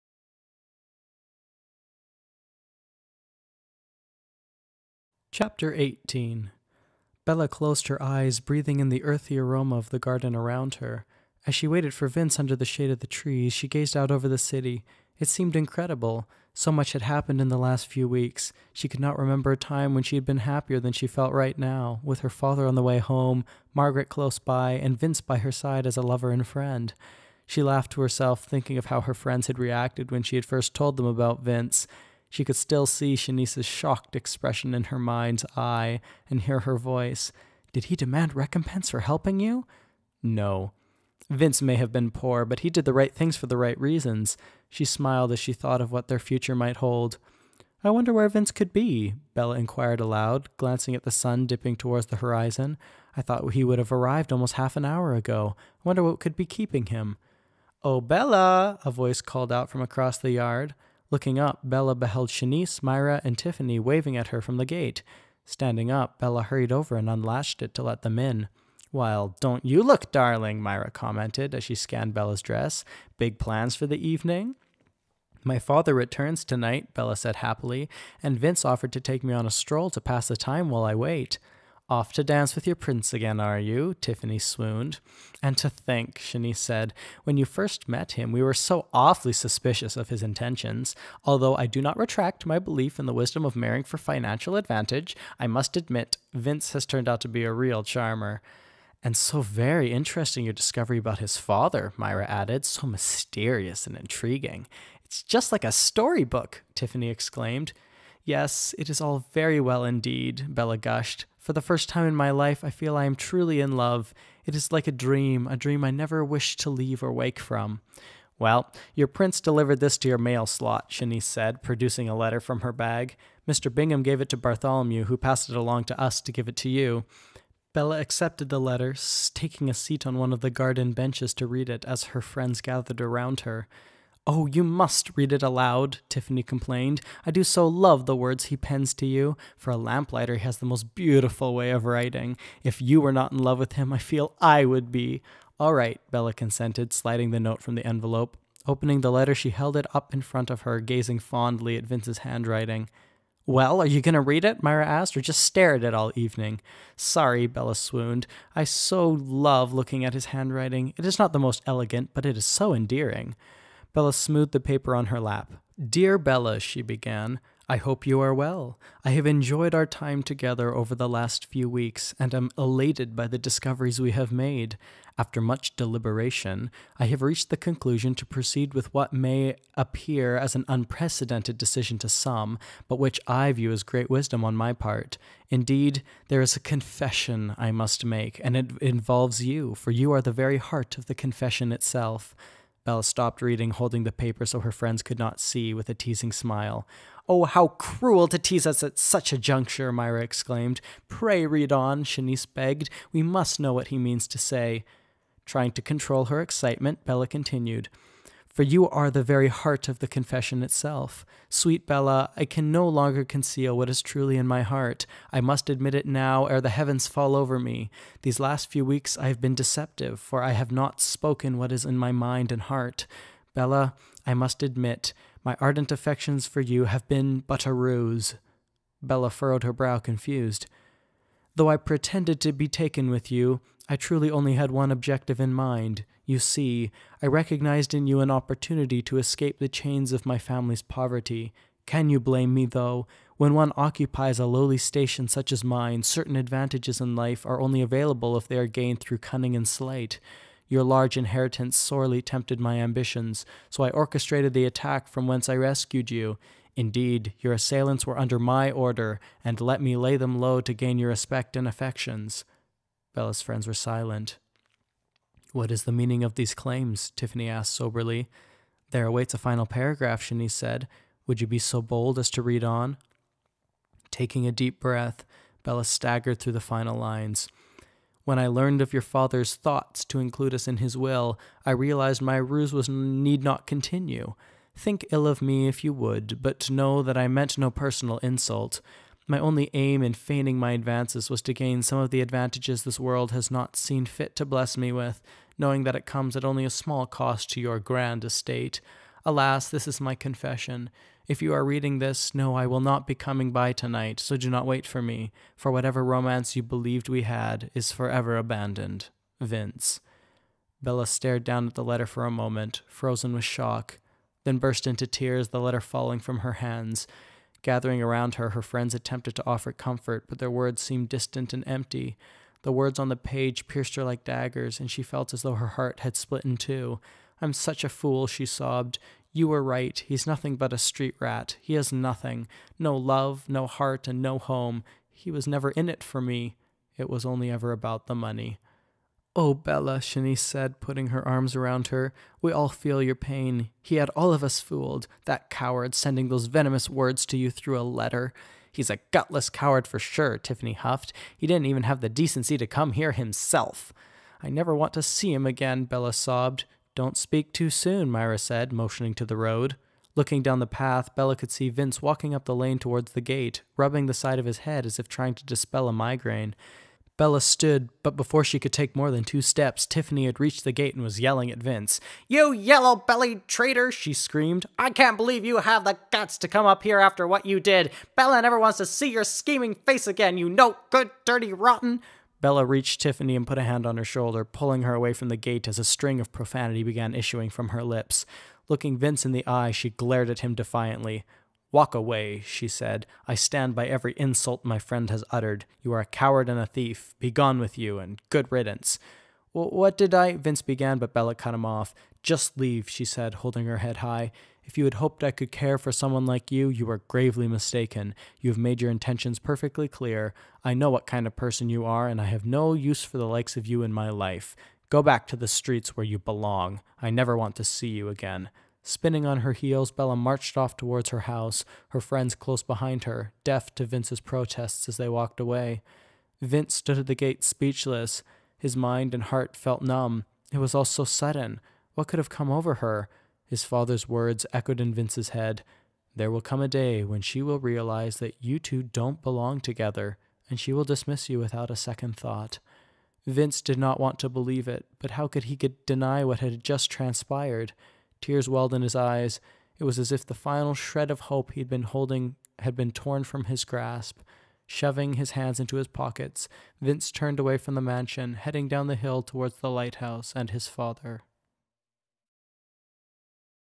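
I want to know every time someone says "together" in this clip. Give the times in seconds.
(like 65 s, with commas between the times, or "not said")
170 s, 439 s.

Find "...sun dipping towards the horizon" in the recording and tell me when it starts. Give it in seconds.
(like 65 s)
51 s.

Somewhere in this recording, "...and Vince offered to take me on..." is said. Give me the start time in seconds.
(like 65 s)
78 s.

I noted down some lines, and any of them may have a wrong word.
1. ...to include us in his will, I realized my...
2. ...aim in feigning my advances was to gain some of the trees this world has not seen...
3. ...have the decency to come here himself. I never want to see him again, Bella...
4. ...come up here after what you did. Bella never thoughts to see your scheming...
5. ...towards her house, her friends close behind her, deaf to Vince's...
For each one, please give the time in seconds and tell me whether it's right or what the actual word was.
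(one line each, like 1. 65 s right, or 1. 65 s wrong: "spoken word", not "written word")
1. 280 s right
2. 289 s wrong: "advantages", not "trees"
3. 351 s right
4. 376 s wrong: "wants", not "thoughts"
5. 420 s right.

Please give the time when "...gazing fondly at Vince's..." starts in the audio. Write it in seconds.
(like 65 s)
150 s.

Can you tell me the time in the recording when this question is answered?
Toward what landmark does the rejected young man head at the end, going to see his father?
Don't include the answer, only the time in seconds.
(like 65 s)
459 s.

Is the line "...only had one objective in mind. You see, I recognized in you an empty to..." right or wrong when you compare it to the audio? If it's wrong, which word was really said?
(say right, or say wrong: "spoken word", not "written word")
wrong: "opportunity", not "empty".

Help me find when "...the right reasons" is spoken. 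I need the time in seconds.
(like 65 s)
43 s.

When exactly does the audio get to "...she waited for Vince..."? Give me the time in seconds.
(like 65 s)
11 s.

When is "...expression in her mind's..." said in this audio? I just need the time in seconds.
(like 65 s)
34 s.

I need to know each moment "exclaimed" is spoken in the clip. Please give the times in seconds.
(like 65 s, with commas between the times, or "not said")
107 s, 200 s.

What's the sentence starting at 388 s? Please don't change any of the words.
Looking Vince in the eye, she glared at him defiantly.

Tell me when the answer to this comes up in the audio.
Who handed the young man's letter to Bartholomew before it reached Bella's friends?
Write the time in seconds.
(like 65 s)
123 s.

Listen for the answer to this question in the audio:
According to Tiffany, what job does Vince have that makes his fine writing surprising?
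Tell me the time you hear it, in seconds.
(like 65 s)
139 s.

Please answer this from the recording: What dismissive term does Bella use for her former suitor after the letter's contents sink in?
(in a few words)
Street rat.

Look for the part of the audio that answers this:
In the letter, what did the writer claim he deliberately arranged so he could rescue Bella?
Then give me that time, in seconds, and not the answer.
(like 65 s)
254 s.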